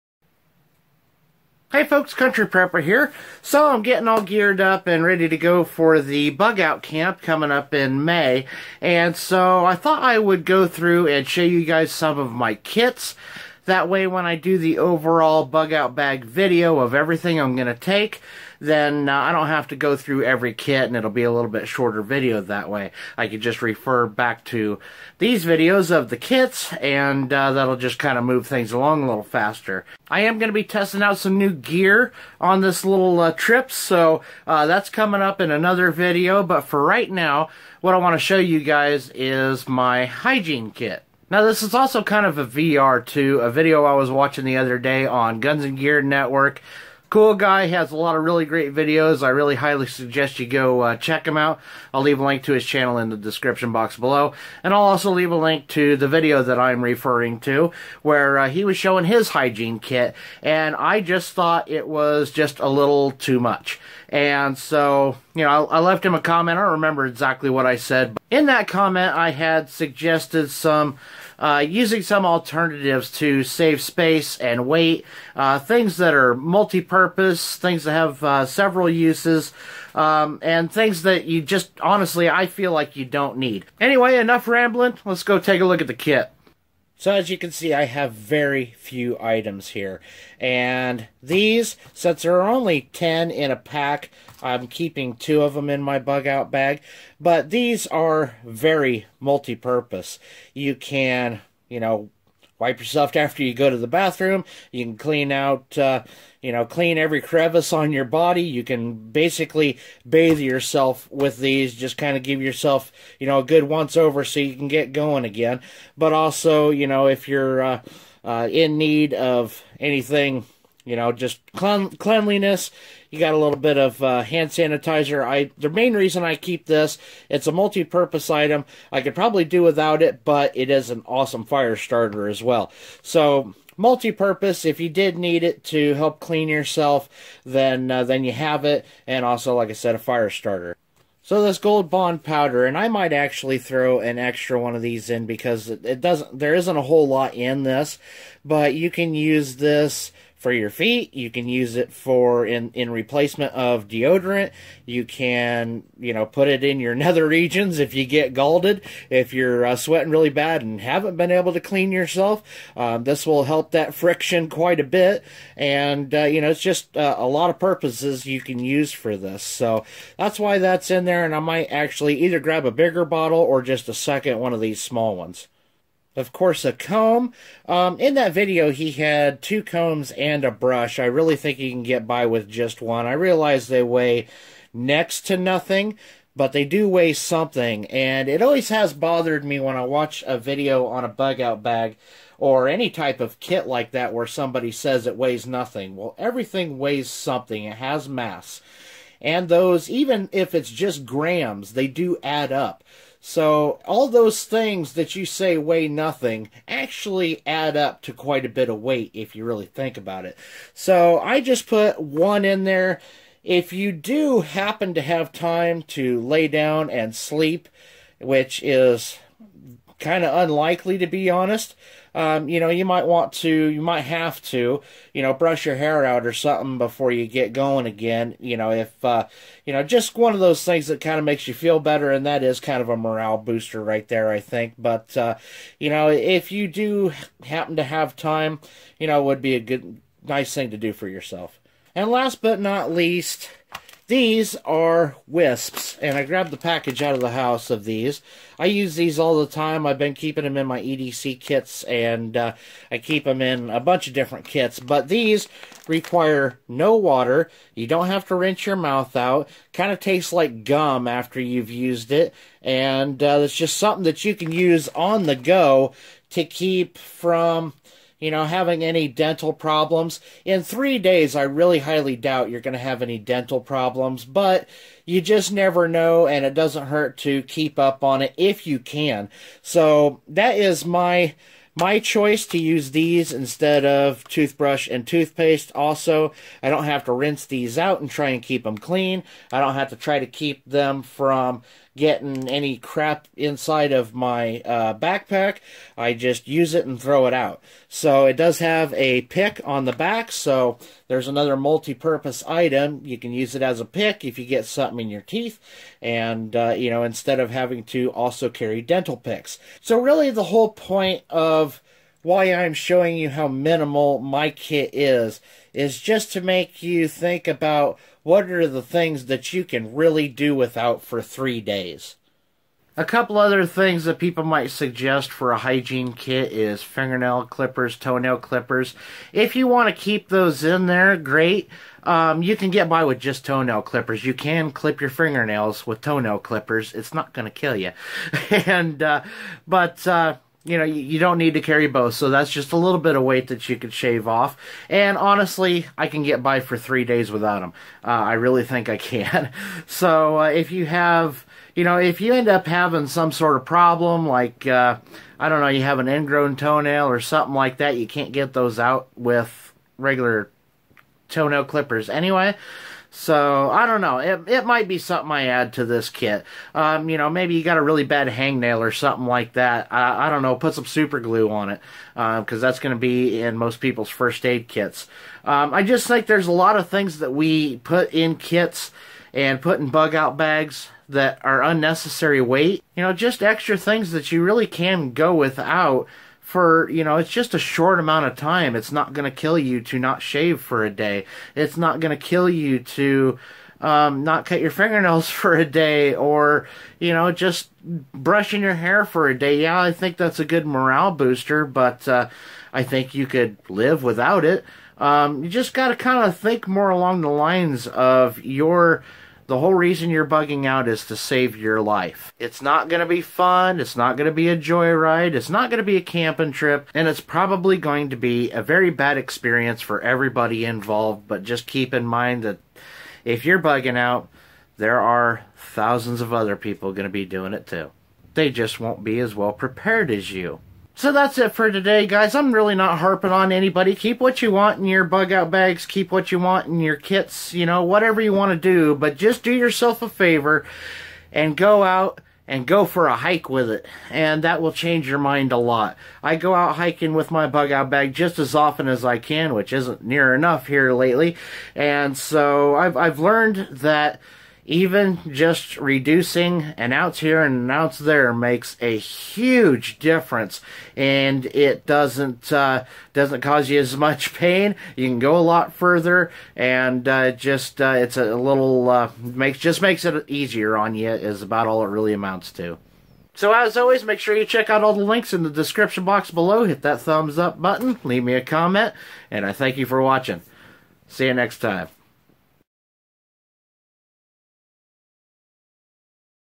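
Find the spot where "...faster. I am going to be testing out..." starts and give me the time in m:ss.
0:29.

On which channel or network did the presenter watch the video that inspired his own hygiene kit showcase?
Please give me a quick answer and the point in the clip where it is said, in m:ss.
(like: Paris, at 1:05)
Guns and Gear Network, at 0:45.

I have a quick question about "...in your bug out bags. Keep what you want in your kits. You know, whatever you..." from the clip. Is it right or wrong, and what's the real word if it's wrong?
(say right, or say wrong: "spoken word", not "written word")
right.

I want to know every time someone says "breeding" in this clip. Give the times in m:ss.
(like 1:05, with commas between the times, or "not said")
not said.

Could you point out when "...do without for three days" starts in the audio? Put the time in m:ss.
5:20.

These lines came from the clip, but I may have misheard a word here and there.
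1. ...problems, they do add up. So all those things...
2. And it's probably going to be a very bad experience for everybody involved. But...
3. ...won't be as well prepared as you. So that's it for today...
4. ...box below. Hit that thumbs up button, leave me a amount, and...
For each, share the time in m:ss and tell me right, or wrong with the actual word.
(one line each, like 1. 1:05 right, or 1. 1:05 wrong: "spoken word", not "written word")
1. 3:21 wrong: "grams", not "problems"
2. 6:56 right
3. 7:08 right
4. 7:56 wrong: "comment", not "amount".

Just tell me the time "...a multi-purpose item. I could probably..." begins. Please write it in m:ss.
2:07.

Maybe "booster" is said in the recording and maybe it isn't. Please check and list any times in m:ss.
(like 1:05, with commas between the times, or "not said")
3:53, 6:41.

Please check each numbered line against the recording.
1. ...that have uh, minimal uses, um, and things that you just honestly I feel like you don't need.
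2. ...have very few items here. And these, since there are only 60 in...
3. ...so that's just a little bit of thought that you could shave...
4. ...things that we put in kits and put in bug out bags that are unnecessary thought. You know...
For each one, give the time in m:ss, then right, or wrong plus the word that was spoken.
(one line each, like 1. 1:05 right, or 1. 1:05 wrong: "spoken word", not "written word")
1. 1:17 wrong: "several", not "minimal"
2. 1:27 wrong: "10", not "60"
3. 5:42 wrong: "weight", not "thought"
4. 6:16 wrong: "weight", not "thought".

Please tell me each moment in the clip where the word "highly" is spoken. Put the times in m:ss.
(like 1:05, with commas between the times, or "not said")
0:49, 4:31.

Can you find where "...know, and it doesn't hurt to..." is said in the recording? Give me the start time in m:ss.
4:35.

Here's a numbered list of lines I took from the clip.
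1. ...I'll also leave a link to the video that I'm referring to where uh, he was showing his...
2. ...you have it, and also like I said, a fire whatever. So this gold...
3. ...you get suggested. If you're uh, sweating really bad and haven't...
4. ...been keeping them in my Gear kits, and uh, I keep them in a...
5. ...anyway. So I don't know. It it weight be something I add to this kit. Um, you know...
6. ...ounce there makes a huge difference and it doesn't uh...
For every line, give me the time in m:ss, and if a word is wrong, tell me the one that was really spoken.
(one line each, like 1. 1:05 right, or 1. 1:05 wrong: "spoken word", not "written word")
1. 0:54 right
2. 2:18 wrong: "starter", not "whatever"
3. 2:37 wrong: "scalded", not "suggested"
4. 4:09 wrong: "EDC", not "Gear"
5. 6:02 wrong: "might", not "weight"
6. 7:37 right.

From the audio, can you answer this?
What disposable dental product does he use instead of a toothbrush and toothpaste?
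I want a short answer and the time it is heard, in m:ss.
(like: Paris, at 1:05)
Wisps, at 4:05.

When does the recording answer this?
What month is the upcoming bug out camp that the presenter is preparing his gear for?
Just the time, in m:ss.
0:08.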